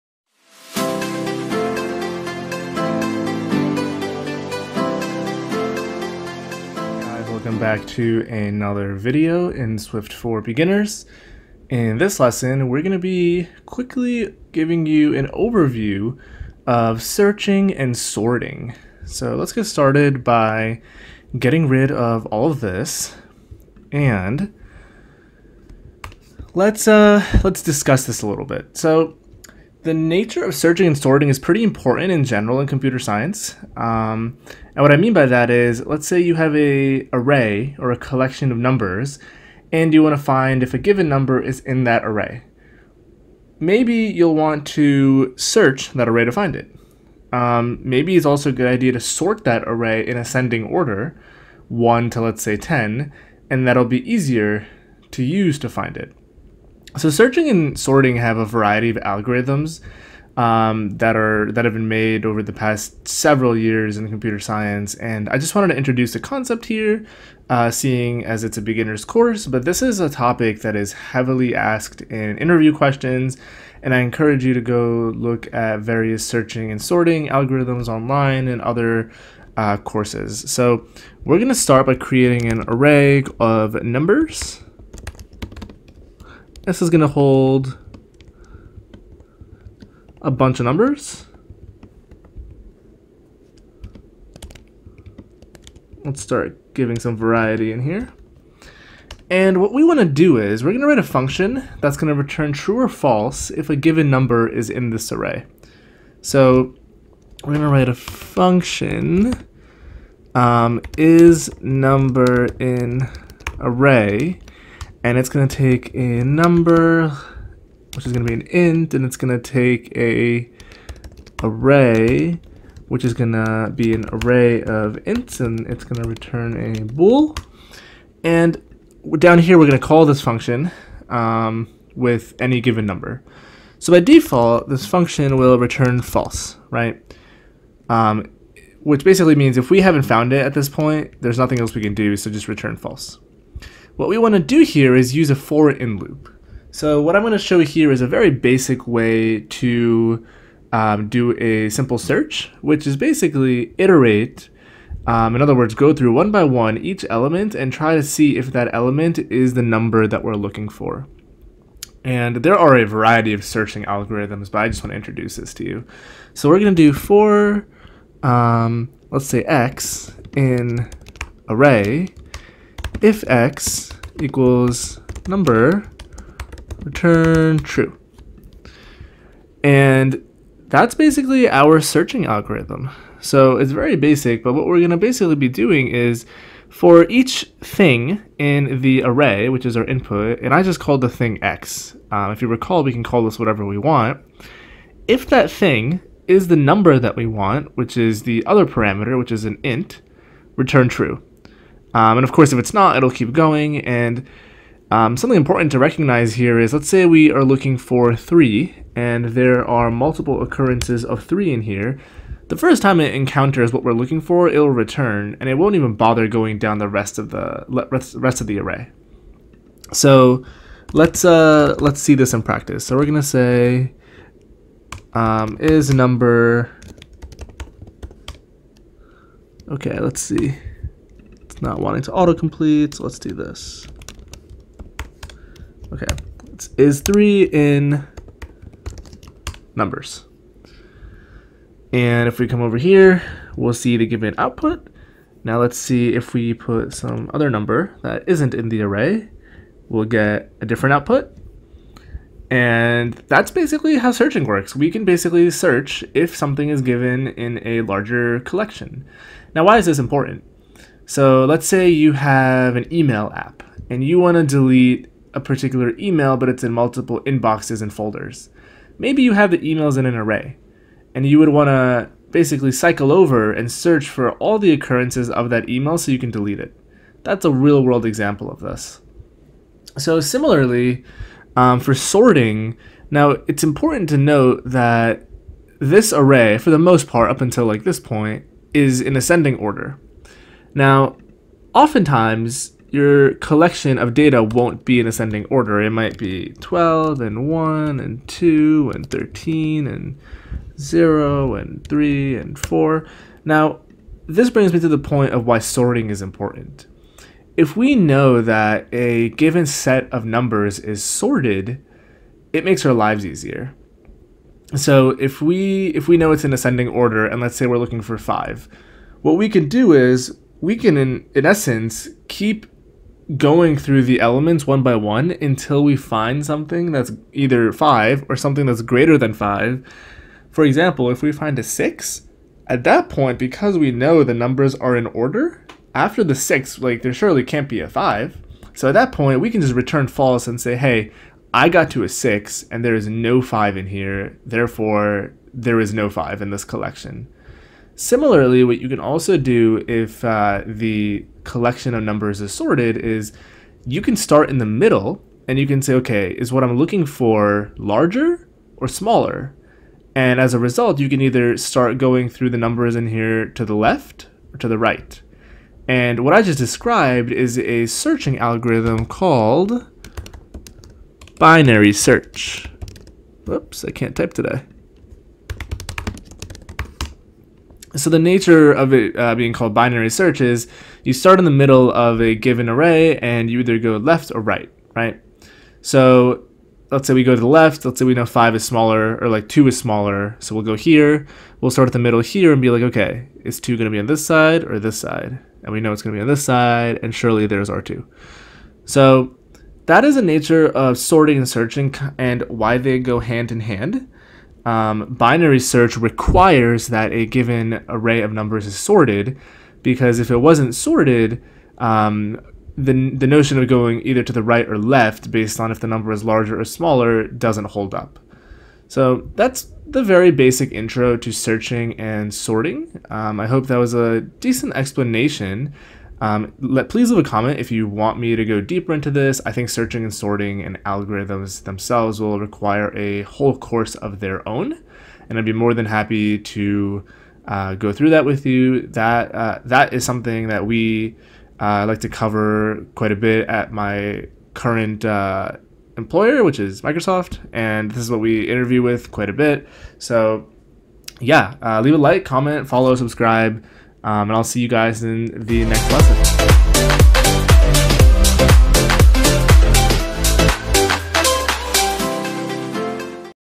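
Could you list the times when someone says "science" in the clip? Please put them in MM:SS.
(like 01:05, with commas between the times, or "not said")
00:32, 01:04.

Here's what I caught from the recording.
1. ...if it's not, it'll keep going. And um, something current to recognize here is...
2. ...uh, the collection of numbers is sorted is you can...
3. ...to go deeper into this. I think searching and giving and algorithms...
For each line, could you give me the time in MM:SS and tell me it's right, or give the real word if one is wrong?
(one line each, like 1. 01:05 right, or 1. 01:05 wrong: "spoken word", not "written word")
1. 03:22 wrong: "important", not "current"
2. 05:50 right
3. 07:08 wrong: "sorting", not "giving".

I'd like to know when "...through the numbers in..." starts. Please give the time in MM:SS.
06:02.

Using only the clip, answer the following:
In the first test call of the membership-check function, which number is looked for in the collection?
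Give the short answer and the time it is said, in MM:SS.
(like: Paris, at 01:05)
3, at 03:57.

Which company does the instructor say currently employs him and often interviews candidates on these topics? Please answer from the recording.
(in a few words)
Microsoft.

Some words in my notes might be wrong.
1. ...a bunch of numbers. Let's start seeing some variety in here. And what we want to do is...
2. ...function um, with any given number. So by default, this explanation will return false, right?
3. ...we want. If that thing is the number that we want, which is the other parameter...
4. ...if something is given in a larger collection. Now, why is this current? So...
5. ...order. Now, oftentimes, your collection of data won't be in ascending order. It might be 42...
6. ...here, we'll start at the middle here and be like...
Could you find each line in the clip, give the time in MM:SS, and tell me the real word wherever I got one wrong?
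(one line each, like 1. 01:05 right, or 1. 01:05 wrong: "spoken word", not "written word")
1. 01:30 wrong: "giving", not "seeing"
2. 02:10 wrong: "function", not "explanation"
3. 03:13 right
4. 04:16 wrong: "important", not "current"
5. 04:49 wrong: "12", not "42"
6. 06:30 right.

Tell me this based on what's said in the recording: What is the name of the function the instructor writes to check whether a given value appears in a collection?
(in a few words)
is number in array.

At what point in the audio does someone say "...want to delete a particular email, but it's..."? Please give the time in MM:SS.
04:24.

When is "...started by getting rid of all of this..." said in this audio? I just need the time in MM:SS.
00:19.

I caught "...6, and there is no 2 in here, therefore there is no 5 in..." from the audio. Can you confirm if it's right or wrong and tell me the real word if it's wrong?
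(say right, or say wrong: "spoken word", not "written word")
wrong: "5", not "2".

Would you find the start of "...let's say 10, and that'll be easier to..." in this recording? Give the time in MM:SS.
00:52.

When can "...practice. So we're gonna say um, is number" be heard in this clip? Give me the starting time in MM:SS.
03:42.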